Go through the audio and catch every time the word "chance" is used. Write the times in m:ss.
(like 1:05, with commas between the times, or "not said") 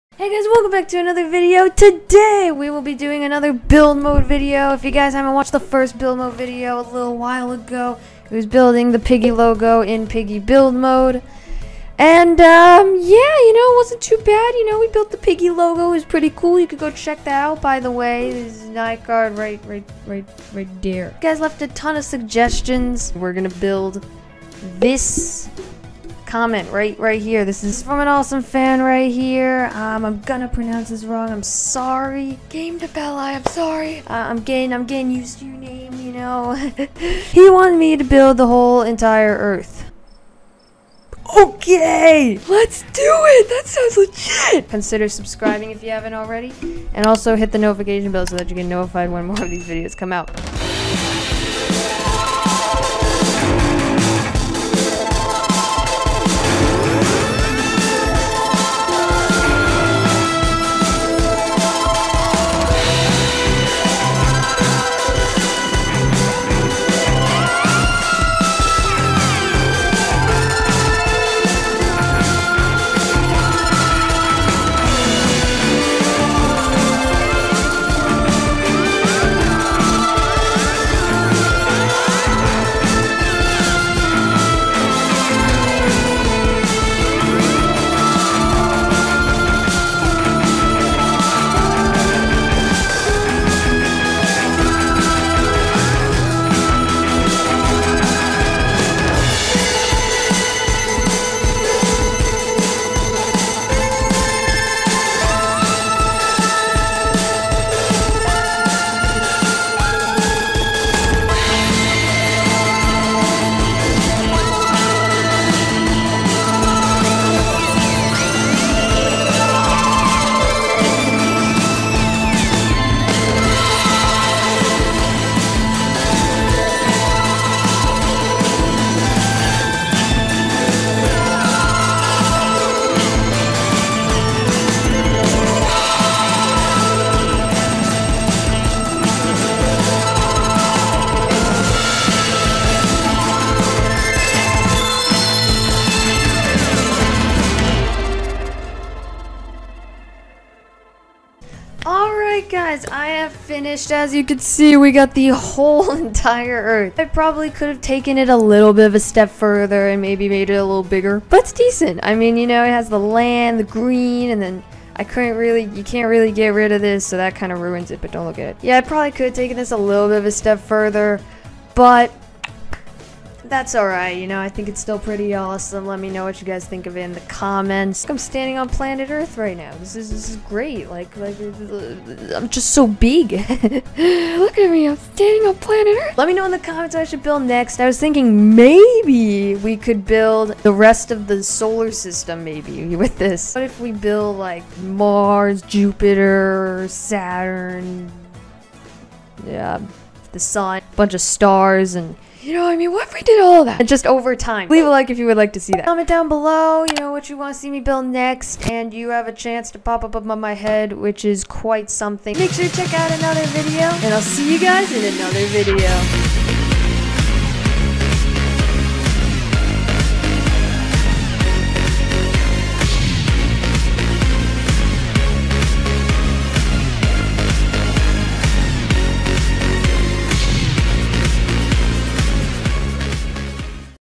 3:29.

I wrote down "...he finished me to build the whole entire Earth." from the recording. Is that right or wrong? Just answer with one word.
wrong.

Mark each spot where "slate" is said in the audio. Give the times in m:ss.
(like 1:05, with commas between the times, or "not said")
not said.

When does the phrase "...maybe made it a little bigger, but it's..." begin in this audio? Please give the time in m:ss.
2:40.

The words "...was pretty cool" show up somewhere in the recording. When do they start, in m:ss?
0:15.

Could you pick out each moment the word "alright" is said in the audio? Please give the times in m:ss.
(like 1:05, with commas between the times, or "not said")
2:53.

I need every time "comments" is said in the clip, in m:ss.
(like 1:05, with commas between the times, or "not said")
0:26, 2:57, 3:06, 3:25.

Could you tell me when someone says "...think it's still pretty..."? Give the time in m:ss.
2:54.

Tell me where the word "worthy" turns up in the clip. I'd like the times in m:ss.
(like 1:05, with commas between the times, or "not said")
not said.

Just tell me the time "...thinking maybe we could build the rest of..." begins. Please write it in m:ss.
3:07.